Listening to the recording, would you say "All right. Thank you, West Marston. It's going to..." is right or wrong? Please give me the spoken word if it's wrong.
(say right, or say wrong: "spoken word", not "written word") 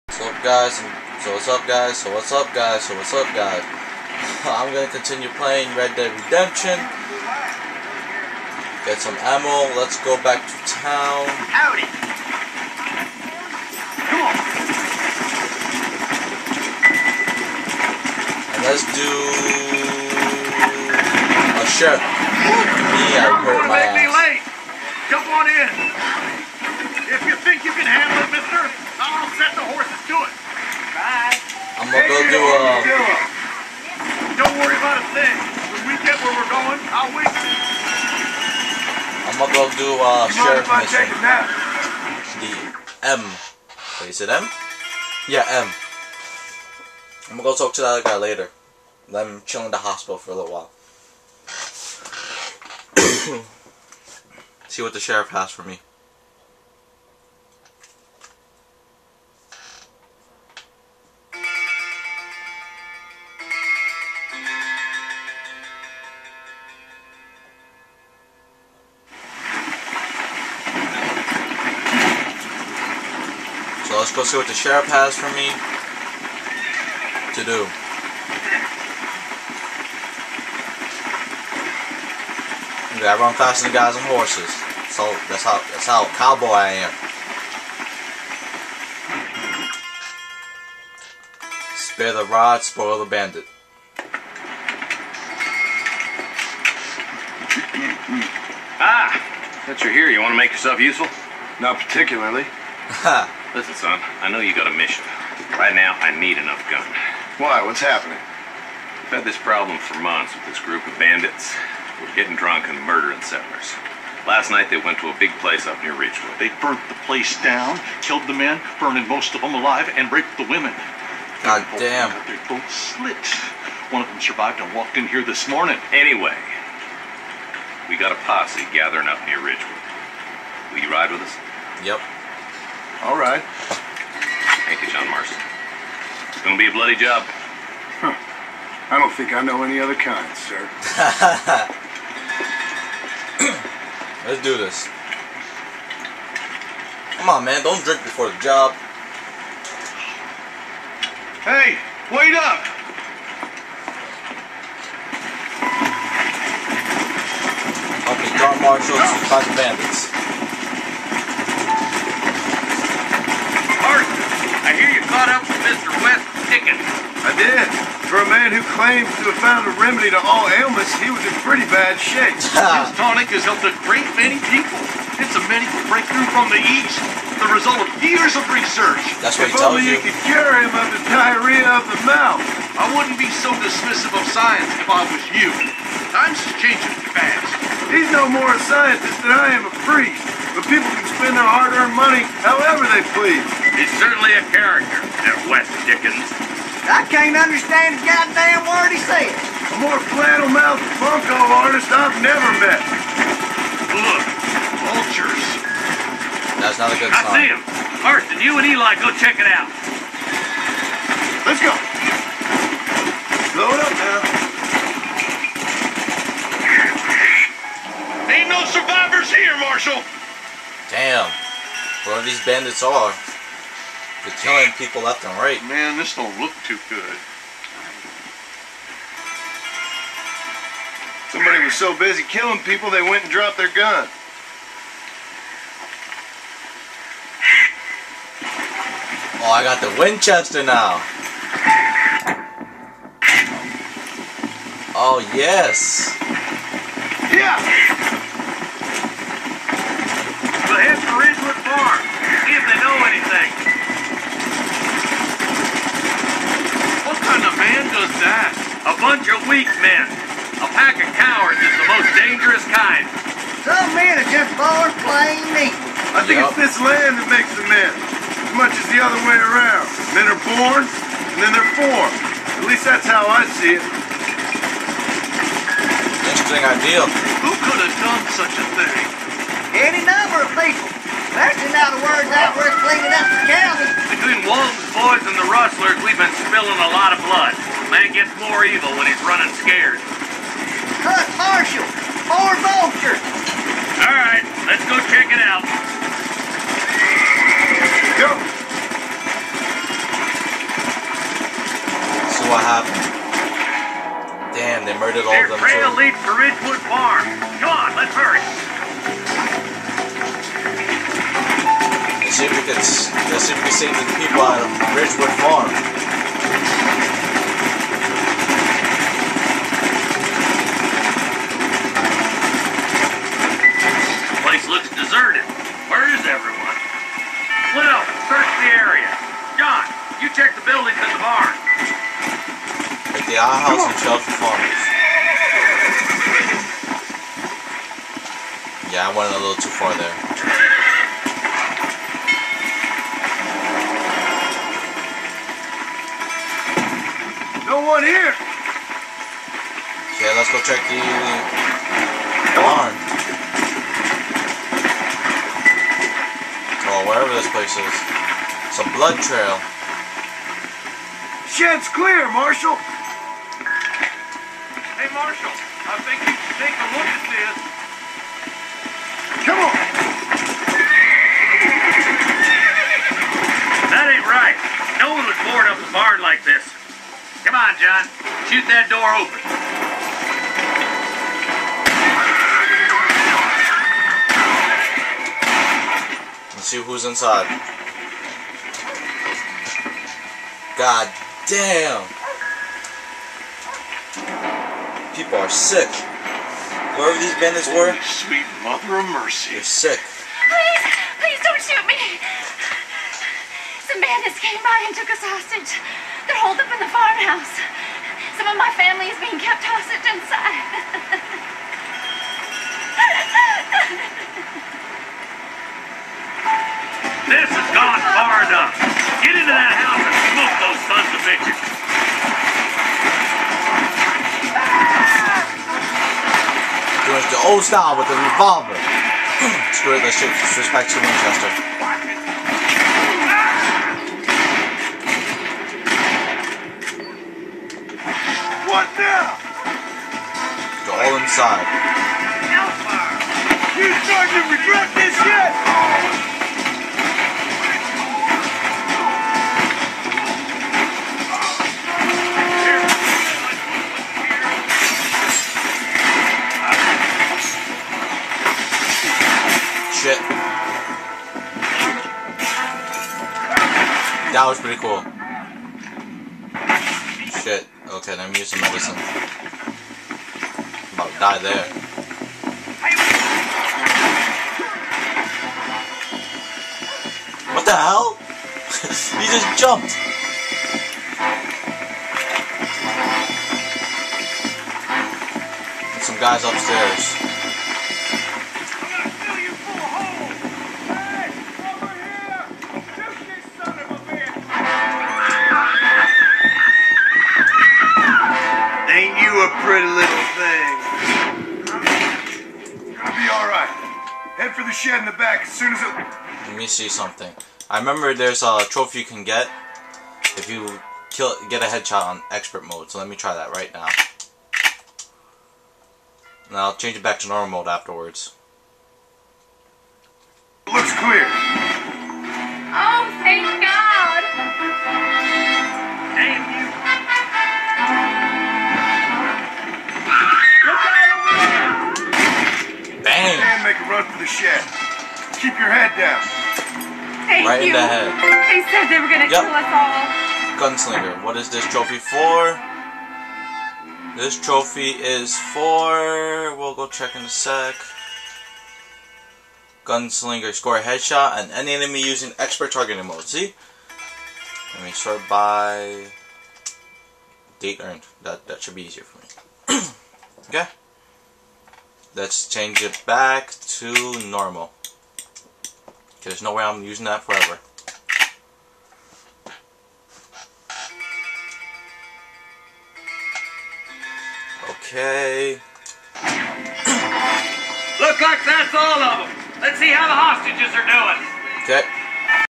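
wrong: "John", not "West".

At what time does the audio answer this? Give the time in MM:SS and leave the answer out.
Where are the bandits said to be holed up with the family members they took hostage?
06:46.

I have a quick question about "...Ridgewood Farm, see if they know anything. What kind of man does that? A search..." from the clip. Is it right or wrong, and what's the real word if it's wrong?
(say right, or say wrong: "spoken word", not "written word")
wrong: "bunch", not "search".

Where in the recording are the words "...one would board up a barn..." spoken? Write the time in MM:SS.
06:15.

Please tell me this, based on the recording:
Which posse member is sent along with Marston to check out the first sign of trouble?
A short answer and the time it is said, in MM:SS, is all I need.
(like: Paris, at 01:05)
Eli, at 03:28.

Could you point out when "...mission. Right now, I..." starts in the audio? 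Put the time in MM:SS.
01:44.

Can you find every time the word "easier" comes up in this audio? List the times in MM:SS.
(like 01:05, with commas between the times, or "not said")
09:18.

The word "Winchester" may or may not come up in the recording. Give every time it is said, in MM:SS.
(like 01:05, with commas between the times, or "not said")
03:59, 07:11.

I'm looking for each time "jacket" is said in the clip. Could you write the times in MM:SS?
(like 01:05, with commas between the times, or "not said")
not said.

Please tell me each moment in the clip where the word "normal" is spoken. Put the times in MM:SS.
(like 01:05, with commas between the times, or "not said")
08:37, 09:24.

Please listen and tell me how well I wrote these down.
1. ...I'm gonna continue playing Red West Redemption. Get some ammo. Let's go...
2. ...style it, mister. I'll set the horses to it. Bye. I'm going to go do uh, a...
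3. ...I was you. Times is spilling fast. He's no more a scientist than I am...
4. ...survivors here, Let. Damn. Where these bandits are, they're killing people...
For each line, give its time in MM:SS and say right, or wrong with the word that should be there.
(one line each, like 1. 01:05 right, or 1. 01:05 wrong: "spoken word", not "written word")
1. 00:04 wrong: "Dead", not "West"
2. 00:27 wrong: "handle", not "style"
3. 03:04 wrong: "changing", not "spilling"
4. 03:38 wrong: "Marshal", not "Let".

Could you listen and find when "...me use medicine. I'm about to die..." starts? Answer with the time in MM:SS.
07:48.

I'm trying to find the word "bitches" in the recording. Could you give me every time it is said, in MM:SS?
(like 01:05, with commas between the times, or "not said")
07:01.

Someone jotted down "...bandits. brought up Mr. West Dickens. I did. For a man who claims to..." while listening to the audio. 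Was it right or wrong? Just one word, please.
right.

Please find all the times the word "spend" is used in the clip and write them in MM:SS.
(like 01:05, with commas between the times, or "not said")
03:11.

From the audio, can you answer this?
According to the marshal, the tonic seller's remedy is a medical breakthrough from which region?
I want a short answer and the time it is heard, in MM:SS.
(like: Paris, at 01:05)
the East, at 02:56.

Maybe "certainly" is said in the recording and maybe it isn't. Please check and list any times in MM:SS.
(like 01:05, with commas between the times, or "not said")
03:14.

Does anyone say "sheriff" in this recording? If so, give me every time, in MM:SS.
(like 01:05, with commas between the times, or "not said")
00:21, 00:40, 00:55, 01:14.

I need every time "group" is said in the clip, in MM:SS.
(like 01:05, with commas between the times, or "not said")
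01:50.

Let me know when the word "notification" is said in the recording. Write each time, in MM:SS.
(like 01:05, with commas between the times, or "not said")
not said.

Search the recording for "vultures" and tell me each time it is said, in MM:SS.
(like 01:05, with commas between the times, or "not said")
03:24, 04:52.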